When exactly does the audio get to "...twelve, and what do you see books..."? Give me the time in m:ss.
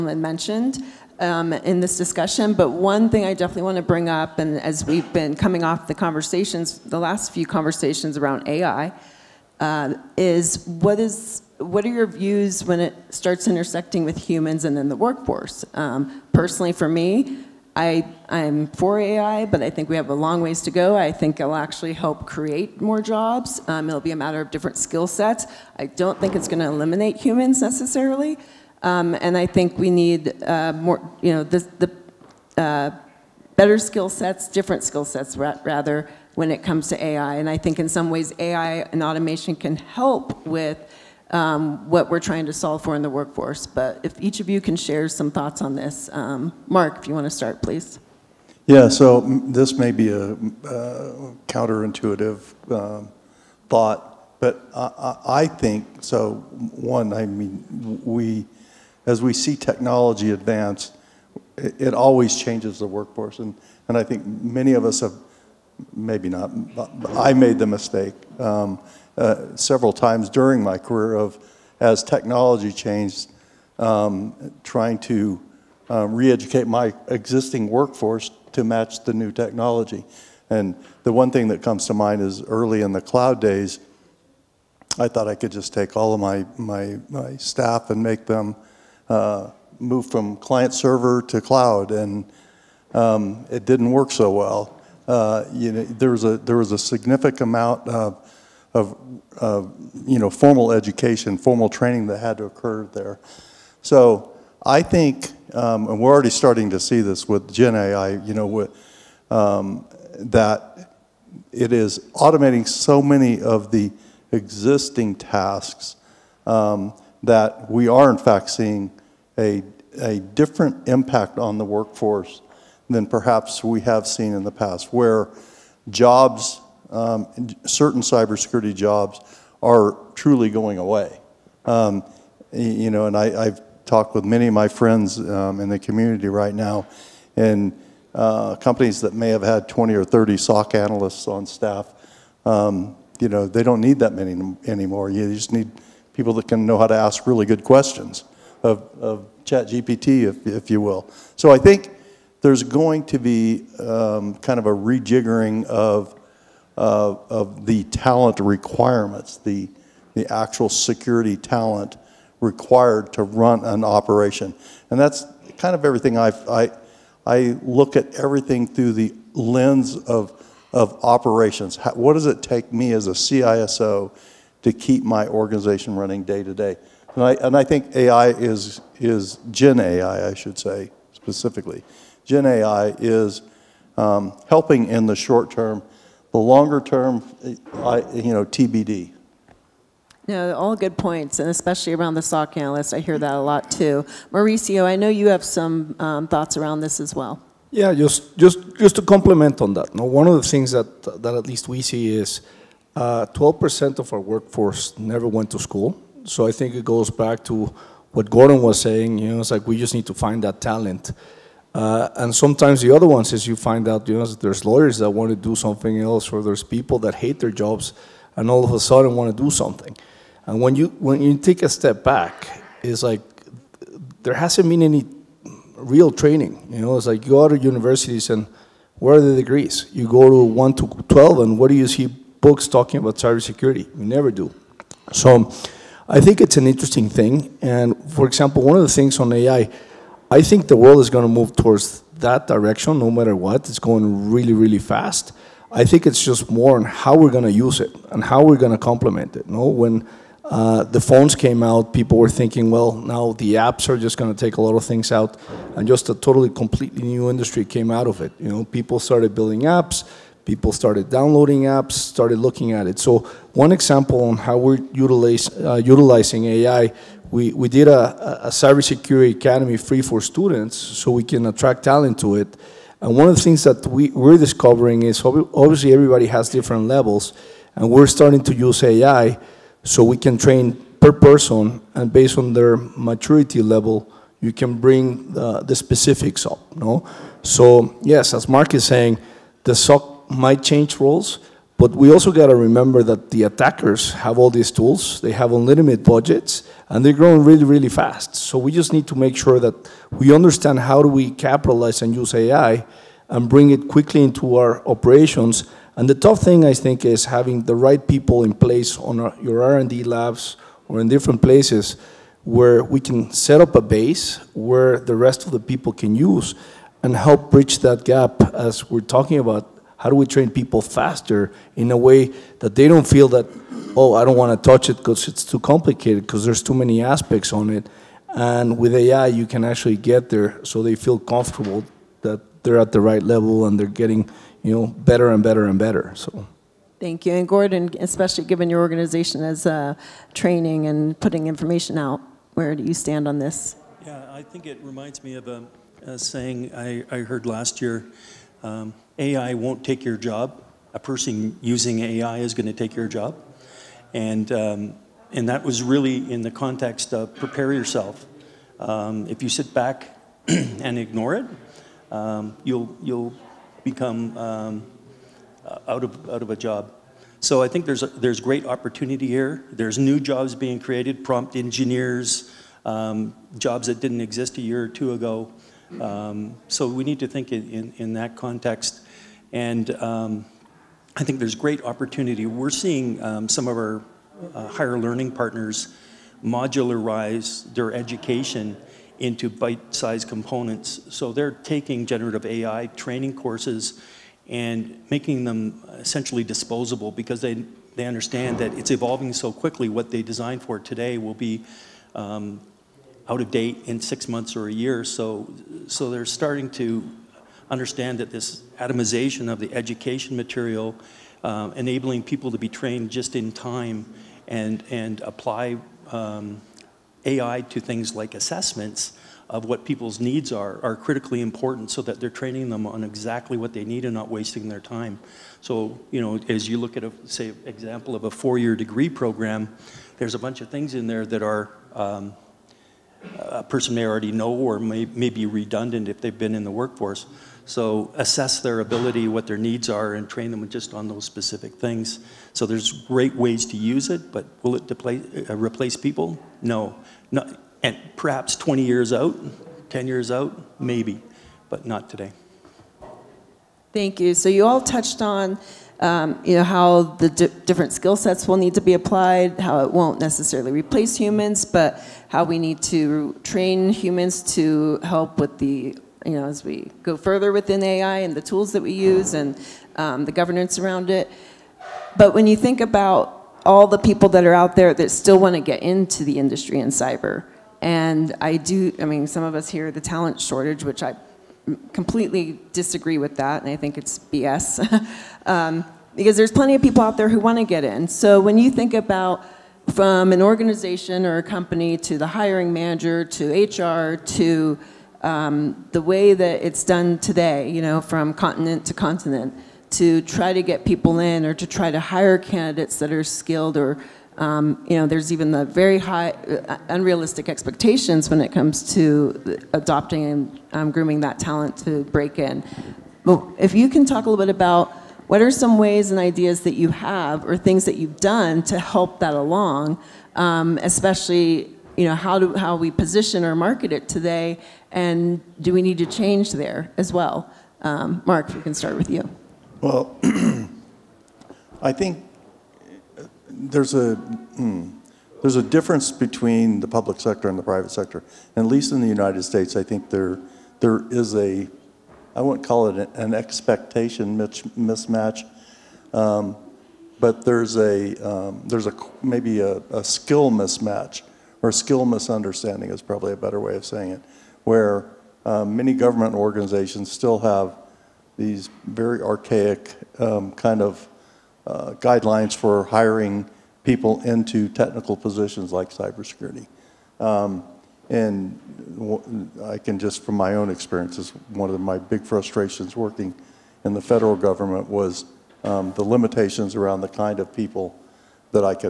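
3:51.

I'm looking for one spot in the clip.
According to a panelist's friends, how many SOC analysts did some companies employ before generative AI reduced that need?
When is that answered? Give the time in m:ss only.
2:19.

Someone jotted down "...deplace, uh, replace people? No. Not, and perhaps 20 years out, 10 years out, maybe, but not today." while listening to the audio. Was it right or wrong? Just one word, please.
right.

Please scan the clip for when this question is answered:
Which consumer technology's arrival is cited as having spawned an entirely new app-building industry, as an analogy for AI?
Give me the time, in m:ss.
4:10.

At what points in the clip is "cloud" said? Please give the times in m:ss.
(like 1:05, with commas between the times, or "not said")
1:23, 1:31.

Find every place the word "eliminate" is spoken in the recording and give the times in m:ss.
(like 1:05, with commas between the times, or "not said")
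0:26.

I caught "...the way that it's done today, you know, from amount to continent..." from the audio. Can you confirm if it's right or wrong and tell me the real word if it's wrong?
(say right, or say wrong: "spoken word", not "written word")
wrong: "continent", not "amount".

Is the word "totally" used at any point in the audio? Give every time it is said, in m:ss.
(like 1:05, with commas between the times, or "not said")
4:16.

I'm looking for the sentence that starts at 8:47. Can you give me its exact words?
Um, Mark, we can start with you.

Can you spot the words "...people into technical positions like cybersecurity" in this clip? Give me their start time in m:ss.
9:23.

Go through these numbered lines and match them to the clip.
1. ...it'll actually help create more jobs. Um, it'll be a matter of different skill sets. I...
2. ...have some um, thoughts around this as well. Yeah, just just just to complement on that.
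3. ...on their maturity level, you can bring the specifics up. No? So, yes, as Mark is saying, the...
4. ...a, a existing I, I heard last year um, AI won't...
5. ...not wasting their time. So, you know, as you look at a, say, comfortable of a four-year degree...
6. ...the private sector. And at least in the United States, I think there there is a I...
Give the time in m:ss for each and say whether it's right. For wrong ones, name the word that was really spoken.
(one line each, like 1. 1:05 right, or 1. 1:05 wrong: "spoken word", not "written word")
1. 0:21 right
2. 3:15 right
3. 4:42 right
4. 5:45 wrong: "saying", not "existing"
5. 7:04 wrong: "example", not "comfortable"
6. 8:57 right.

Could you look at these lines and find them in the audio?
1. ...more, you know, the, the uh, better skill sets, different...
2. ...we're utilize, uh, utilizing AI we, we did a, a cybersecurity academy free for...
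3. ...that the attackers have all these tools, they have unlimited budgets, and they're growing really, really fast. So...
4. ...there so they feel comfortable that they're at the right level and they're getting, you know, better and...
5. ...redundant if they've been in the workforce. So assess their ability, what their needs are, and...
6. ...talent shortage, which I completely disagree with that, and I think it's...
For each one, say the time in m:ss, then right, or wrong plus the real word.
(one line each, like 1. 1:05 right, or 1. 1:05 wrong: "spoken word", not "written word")
1. 0:30 right
2. 4:24 right
3. 4:53 right
4. 5:30 right
5. 7:15 right
6. 8:00 right.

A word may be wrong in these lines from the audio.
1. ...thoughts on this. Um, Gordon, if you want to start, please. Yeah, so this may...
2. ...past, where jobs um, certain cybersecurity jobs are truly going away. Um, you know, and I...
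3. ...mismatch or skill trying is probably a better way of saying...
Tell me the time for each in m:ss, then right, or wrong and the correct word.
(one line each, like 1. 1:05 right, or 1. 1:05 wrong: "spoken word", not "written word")
1. 0:45 wrong: "Mark", not "Gordon"
2. 2:04 right
3. 9:10 wrong: "misunderstanding", not "trying".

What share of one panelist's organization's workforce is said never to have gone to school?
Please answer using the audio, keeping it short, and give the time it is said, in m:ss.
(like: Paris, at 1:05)
12%, at 3:22.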